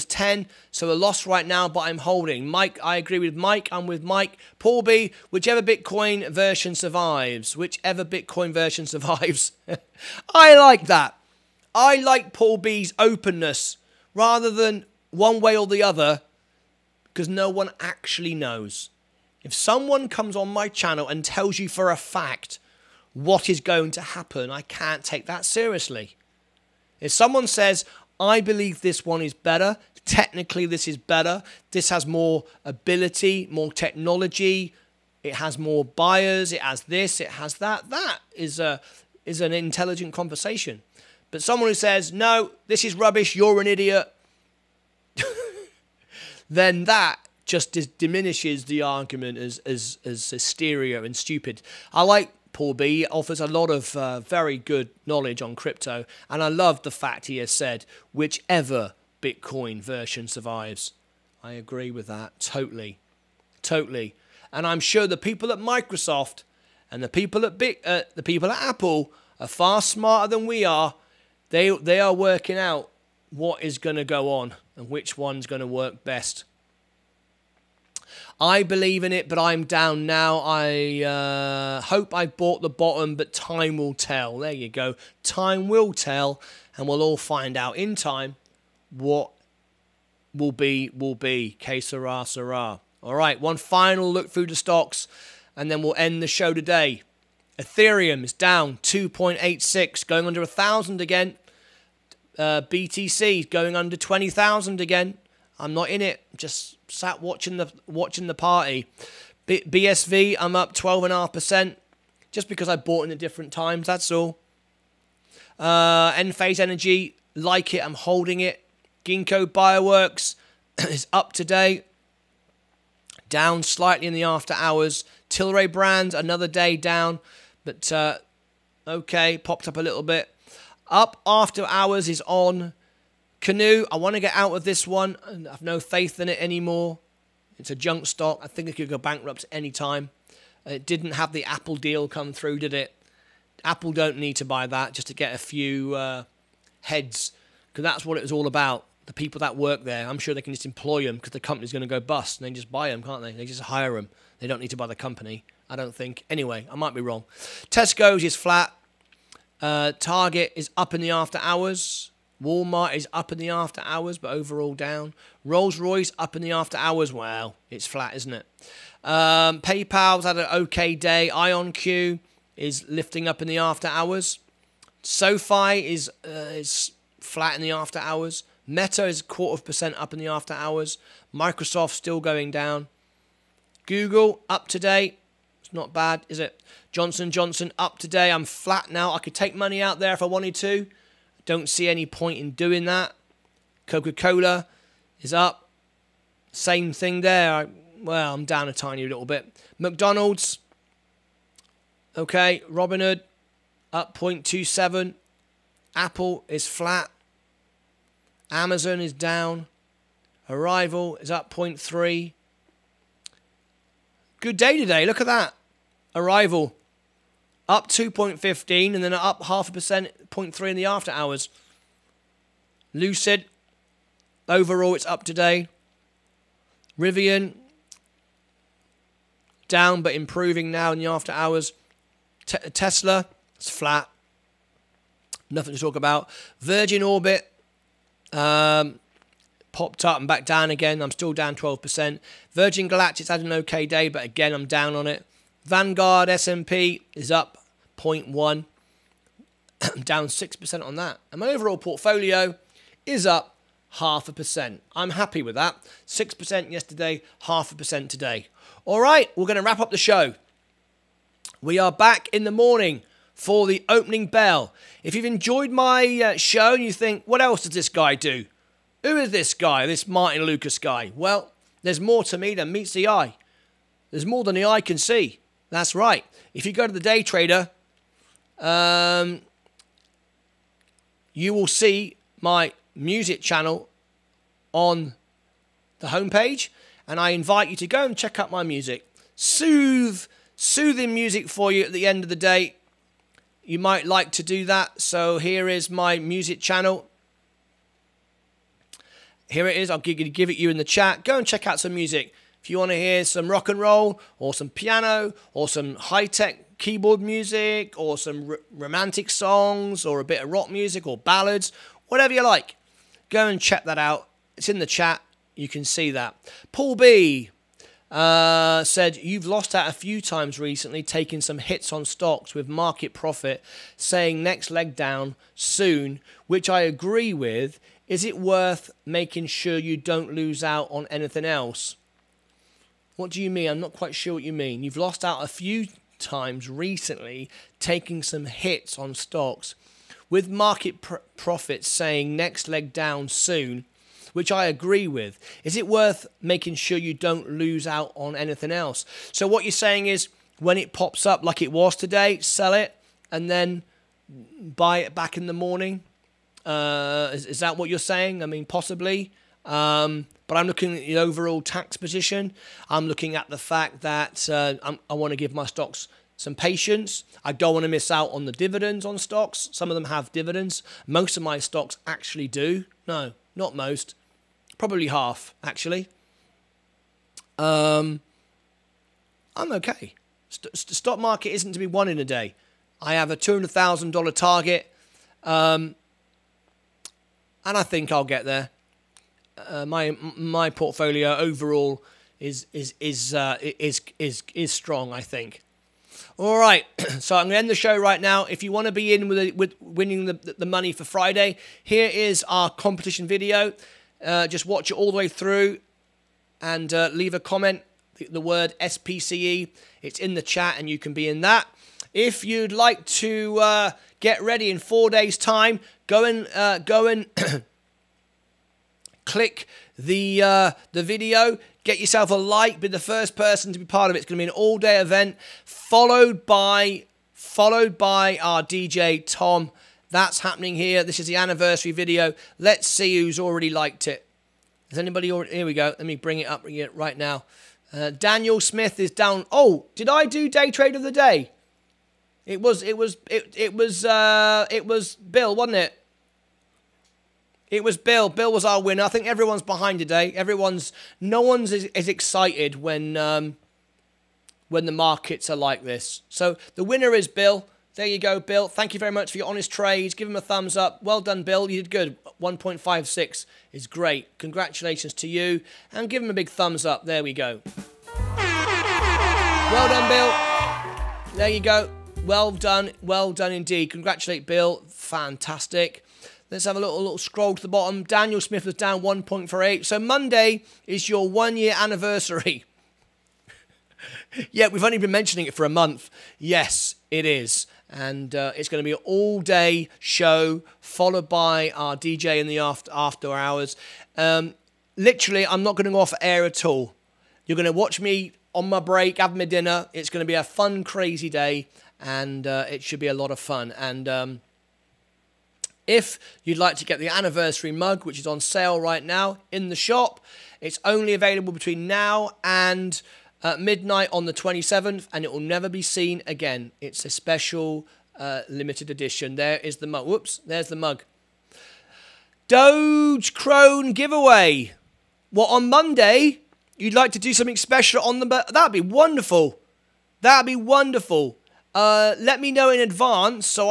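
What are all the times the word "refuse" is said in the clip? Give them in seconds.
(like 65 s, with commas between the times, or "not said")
not said.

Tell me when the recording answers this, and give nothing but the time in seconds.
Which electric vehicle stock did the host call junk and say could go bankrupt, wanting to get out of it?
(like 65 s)
133 s.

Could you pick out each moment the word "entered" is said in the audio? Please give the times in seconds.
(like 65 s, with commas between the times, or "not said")
not said.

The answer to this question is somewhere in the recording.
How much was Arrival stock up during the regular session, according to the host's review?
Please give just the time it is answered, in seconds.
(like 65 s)
217 s.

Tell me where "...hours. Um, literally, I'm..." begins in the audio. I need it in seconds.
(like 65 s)
493 s.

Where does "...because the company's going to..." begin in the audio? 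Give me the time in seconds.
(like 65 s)
151 s.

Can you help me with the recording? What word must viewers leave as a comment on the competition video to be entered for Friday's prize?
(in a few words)
SPCE.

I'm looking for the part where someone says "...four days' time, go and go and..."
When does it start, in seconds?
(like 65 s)
414 s.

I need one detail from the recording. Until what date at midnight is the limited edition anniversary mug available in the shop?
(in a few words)
the 27th.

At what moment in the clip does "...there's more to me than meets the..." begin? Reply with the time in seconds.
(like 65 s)
271 s.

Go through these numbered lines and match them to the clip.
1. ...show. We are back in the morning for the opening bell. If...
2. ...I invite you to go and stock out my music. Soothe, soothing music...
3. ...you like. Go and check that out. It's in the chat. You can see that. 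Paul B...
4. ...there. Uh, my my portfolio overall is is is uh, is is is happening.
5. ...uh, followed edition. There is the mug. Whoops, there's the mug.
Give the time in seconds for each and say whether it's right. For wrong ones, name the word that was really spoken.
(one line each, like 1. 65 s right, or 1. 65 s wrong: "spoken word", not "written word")
1. 259 s right
2. 287 s wrong: "check", not "stock"
3. 312 s right
4. 388 s wrong: "strong", not "happening"
5. 518 s wrong: "limited", not "followed".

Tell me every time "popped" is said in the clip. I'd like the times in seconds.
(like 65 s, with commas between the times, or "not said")
129 s, 239 s.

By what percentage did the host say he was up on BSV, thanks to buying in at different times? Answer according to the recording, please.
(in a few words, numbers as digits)
12.5%.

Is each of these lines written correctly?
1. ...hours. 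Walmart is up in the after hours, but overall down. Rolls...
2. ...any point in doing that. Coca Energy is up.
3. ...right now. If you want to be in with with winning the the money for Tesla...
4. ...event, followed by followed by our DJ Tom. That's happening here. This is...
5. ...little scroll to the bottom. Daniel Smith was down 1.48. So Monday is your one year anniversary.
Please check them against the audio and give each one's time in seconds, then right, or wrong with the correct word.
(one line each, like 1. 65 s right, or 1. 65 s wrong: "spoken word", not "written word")
1. 161 s right
2. 191 s wrong: "Cola", not "Energy"
3. 397 s wrong: "Friday", not "Tesla"
4. 424 s right
5. 476 s right.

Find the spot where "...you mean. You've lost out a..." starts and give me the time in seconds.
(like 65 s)
334 s.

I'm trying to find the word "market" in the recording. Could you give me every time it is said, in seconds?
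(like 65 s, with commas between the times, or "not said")
322 s, 340 s, 381 s, 454 s.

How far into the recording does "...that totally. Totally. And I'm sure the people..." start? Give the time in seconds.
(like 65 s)
62 s.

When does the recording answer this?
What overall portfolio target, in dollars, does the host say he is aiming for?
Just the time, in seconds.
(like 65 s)
383 s.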